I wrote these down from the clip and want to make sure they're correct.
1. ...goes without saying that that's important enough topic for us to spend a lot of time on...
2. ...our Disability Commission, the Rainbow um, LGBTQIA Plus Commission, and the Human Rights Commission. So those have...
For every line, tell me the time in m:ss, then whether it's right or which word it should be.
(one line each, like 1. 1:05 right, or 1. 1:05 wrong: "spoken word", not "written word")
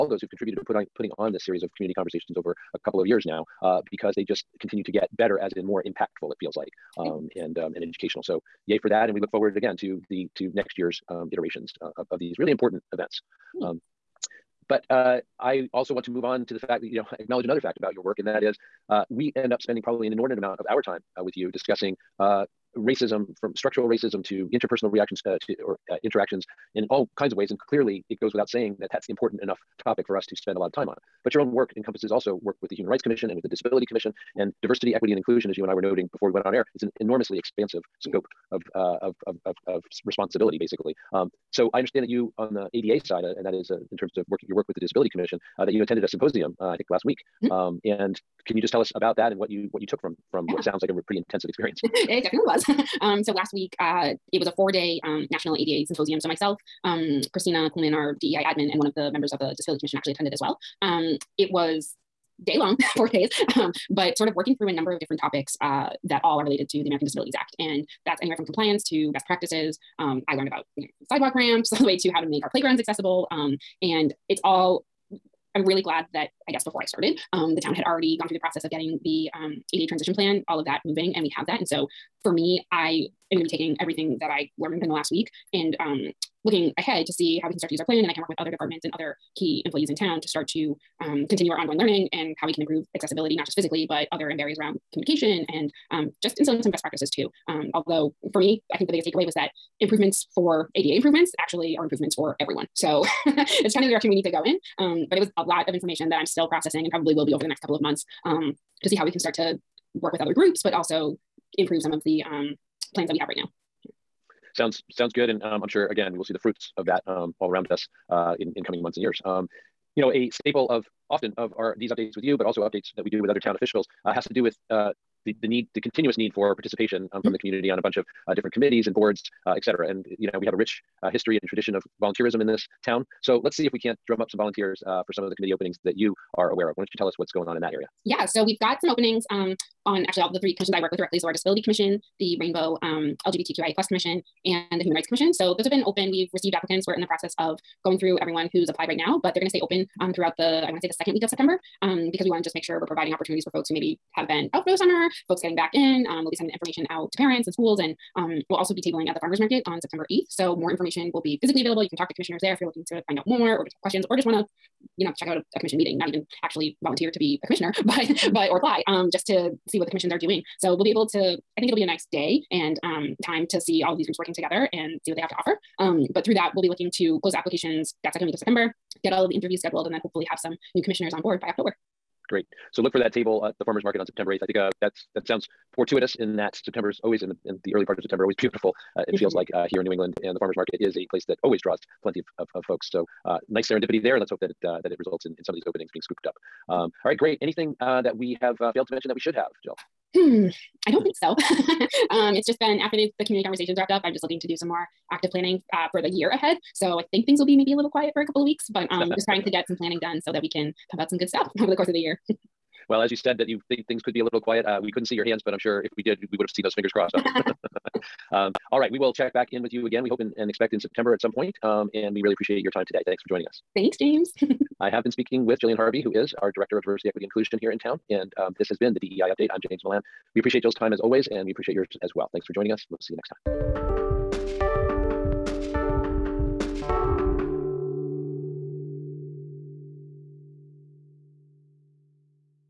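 1. 0:28 right
2. 2:21 right.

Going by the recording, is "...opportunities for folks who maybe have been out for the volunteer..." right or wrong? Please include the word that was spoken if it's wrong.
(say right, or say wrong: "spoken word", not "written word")
wrong: "summer", not "volunteer".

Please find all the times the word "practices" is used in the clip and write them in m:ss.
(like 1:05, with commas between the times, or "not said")
1:09, 1:36.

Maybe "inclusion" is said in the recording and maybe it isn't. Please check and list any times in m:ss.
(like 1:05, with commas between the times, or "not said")
0:35, 3:47.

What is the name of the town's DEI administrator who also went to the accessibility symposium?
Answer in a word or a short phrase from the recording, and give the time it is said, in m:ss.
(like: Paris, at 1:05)
Christina Kuhlman, at 0:57.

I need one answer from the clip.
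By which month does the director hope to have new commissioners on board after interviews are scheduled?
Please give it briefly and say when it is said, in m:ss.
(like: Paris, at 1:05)
October, at 3:01.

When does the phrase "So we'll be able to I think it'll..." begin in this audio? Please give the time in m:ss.
2:50.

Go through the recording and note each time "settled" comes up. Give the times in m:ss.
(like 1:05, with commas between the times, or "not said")
not said.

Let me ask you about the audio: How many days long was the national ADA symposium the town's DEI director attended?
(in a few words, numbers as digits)
4.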